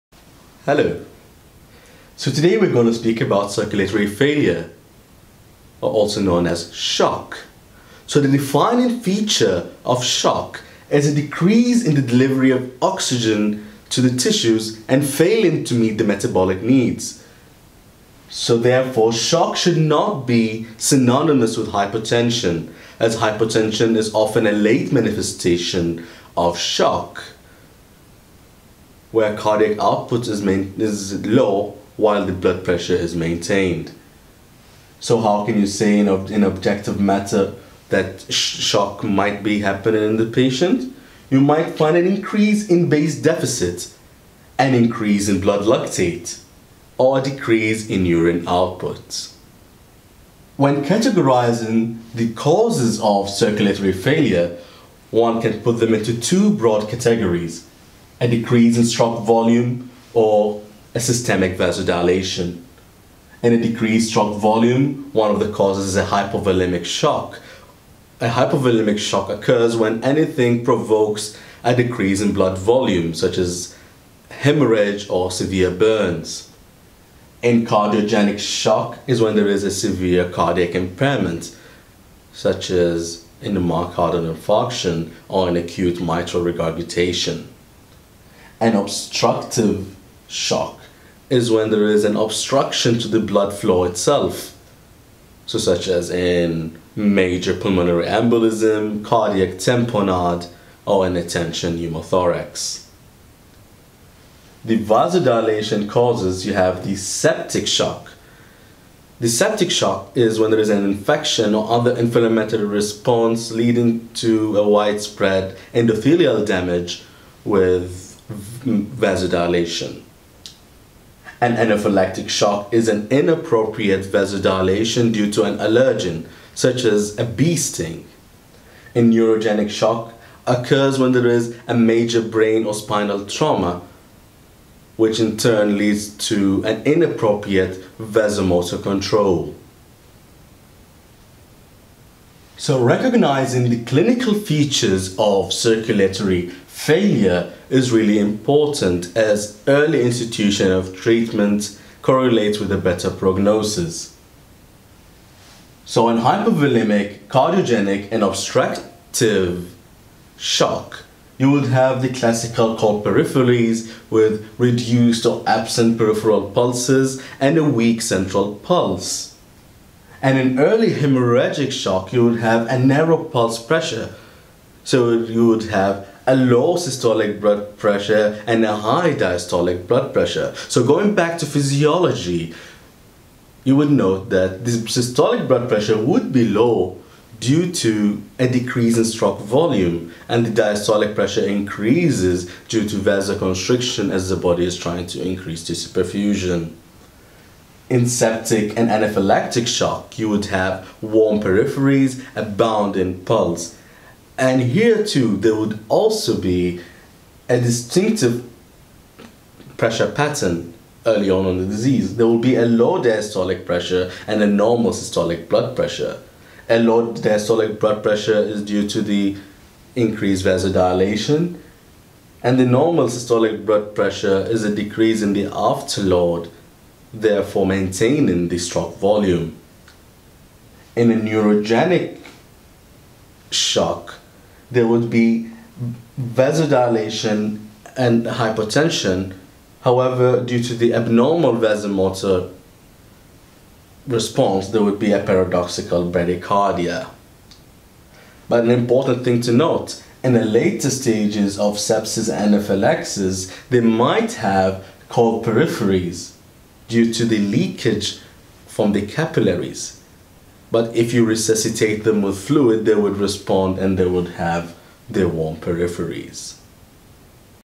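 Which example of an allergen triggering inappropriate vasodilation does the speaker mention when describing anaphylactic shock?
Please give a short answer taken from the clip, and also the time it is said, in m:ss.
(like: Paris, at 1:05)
Bee sting, at 2:07.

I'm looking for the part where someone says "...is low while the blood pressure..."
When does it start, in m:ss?
0:30.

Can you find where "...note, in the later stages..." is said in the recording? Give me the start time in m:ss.
4:09.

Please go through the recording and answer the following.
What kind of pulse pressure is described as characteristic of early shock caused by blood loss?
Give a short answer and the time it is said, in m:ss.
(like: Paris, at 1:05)
Narrow pulse pressure, at 2:52.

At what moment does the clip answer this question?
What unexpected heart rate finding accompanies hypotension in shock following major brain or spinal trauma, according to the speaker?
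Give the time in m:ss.
4:05.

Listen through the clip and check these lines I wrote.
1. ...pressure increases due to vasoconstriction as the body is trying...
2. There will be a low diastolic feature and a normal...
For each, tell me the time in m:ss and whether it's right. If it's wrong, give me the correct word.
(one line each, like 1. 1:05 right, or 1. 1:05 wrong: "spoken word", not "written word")
1. 3:11 right
2. 3:32 wrong: "pressure", not "feature".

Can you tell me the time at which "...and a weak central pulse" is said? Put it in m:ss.
2:47.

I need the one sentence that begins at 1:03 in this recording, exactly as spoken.
In a decreased stroke volume, one of the causes is a hypovolemic shock.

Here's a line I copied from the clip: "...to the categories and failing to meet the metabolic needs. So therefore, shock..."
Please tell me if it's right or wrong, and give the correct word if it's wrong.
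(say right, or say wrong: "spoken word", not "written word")
wrong: "tissues", not "categories".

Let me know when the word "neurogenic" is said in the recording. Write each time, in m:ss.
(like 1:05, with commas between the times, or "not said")
2:08, 3:51.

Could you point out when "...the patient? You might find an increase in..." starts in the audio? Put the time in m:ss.
0:40.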